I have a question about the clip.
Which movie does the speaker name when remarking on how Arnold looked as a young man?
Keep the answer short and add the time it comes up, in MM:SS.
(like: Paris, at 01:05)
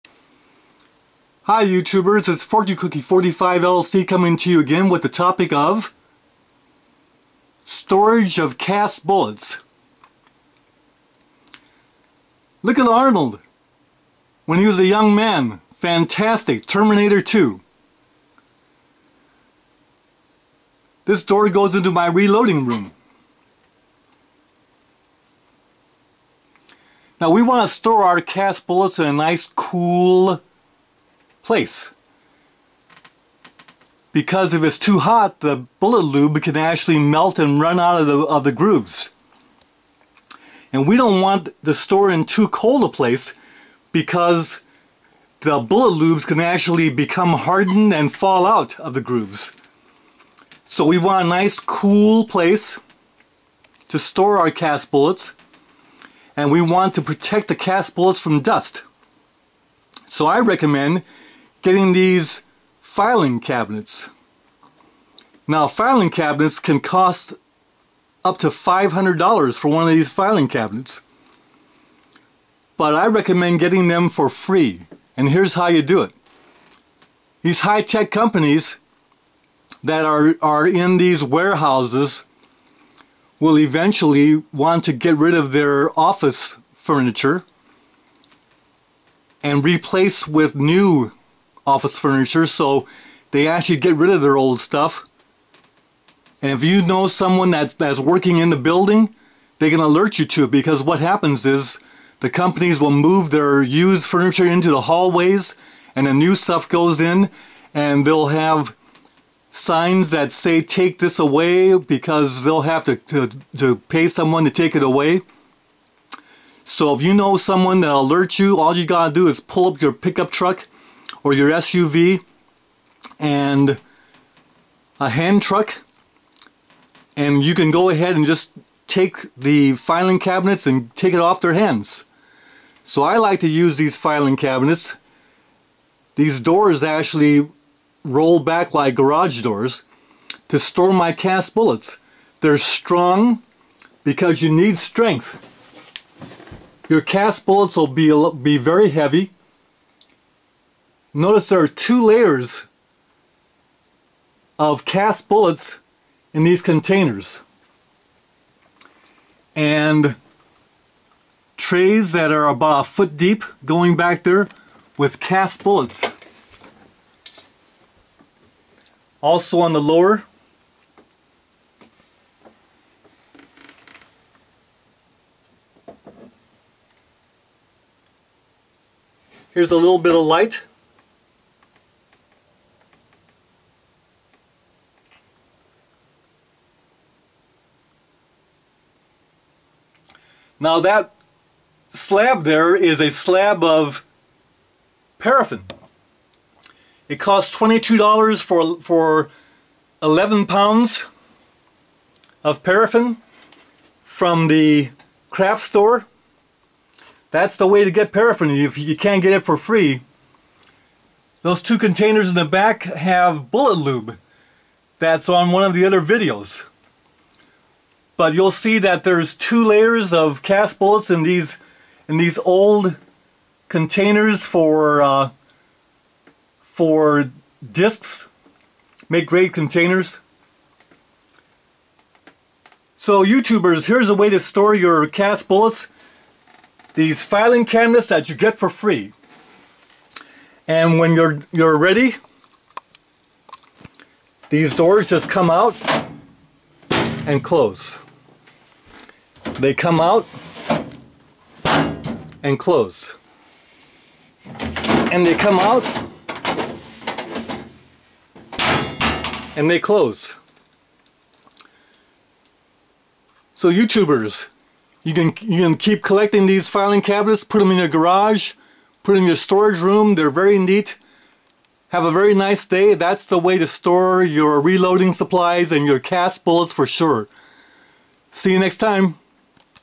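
Terminator 2, at 00:16.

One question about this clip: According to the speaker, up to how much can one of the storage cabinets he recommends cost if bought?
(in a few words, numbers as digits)
$500.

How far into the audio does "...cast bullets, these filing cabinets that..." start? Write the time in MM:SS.
03:55.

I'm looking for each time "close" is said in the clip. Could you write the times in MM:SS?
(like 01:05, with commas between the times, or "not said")
04:07, 04:12, 04:19.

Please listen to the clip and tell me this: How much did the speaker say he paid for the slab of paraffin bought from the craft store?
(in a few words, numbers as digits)
$22.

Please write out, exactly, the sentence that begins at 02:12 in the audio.
So I like to use these filing cabinets.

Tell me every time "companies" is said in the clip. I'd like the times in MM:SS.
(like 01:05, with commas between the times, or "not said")
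01:18, 01:42.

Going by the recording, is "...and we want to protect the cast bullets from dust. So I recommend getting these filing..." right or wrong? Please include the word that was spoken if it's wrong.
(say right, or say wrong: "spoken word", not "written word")
right.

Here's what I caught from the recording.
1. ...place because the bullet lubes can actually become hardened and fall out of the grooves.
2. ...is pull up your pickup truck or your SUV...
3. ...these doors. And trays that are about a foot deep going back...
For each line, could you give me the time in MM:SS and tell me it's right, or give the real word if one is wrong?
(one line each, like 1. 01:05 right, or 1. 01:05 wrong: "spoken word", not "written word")
1. 00:42 right
2. 01:59 right
3. 02:36 wrong: "containers", not "doors".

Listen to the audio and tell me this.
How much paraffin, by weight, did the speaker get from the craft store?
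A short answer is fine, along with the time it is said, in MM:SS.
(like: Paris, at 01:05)
11 pounds, at 03:20.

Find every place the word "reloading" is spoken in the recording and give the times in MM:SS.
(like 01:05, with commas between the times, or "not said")
00:22, 04:34.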